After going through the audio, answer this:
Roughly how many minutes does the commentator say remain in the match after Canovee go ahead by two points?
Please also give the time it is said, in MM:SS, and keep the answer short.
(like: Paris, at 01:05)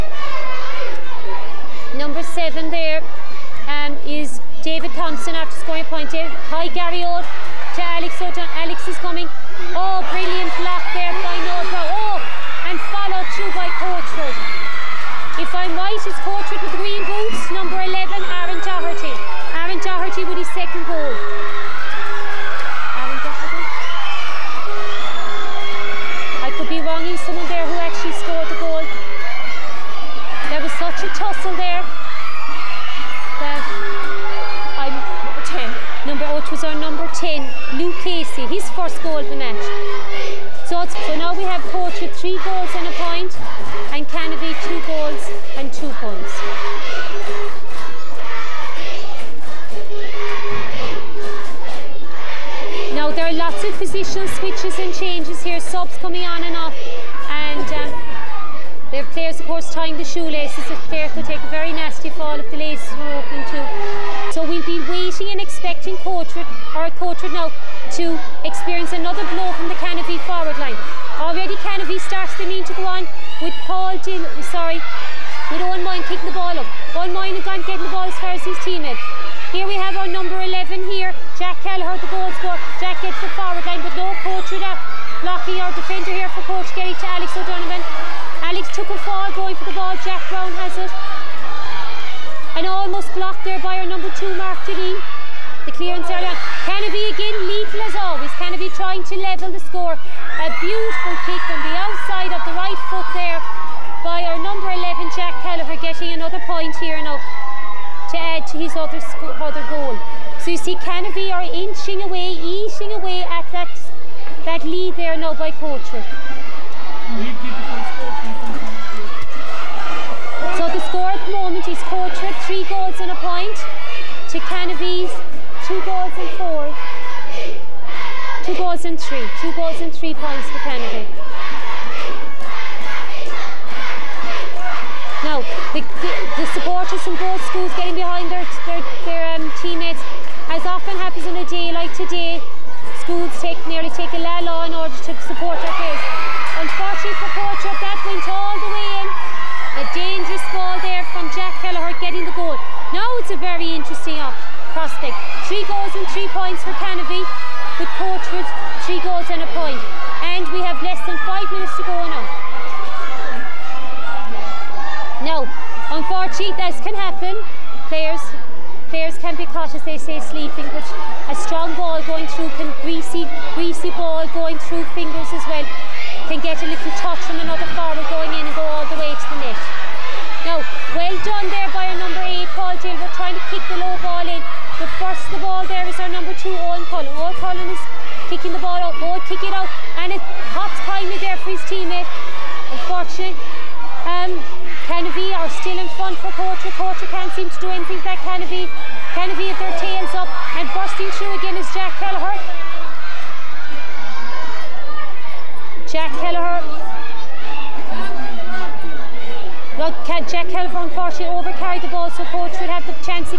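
less than 5, at 02:40.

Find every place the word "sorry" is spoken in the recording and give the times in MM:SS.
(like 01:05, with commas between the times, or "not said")
01:14.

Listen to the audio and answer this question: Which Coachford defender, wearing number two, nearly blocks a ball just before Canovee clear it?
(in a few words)
Mark Janine.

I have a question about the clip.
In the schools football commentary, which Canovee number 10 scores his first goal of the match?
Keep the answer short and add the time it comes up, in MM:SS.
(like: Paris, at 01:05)
Luke Casey, at 00:37.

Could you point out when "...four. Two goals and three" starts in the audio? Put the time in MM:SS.
02:06.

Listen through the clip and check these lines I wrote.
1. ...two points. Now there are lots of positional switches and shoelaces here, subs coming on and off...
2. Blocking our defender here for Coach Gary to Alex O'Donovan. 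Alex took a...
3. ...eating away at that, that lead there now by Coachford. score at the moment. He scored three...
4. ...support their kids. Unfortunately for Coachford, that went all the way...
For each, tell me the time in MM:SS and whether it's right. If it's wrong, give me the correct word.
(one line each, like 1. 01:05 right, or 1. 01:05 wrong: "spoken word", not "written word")
1. 00:45 wrong: "changes", not "shoelaces"
2. 01:25 right
3. 01:52 right
4. 02:25 right.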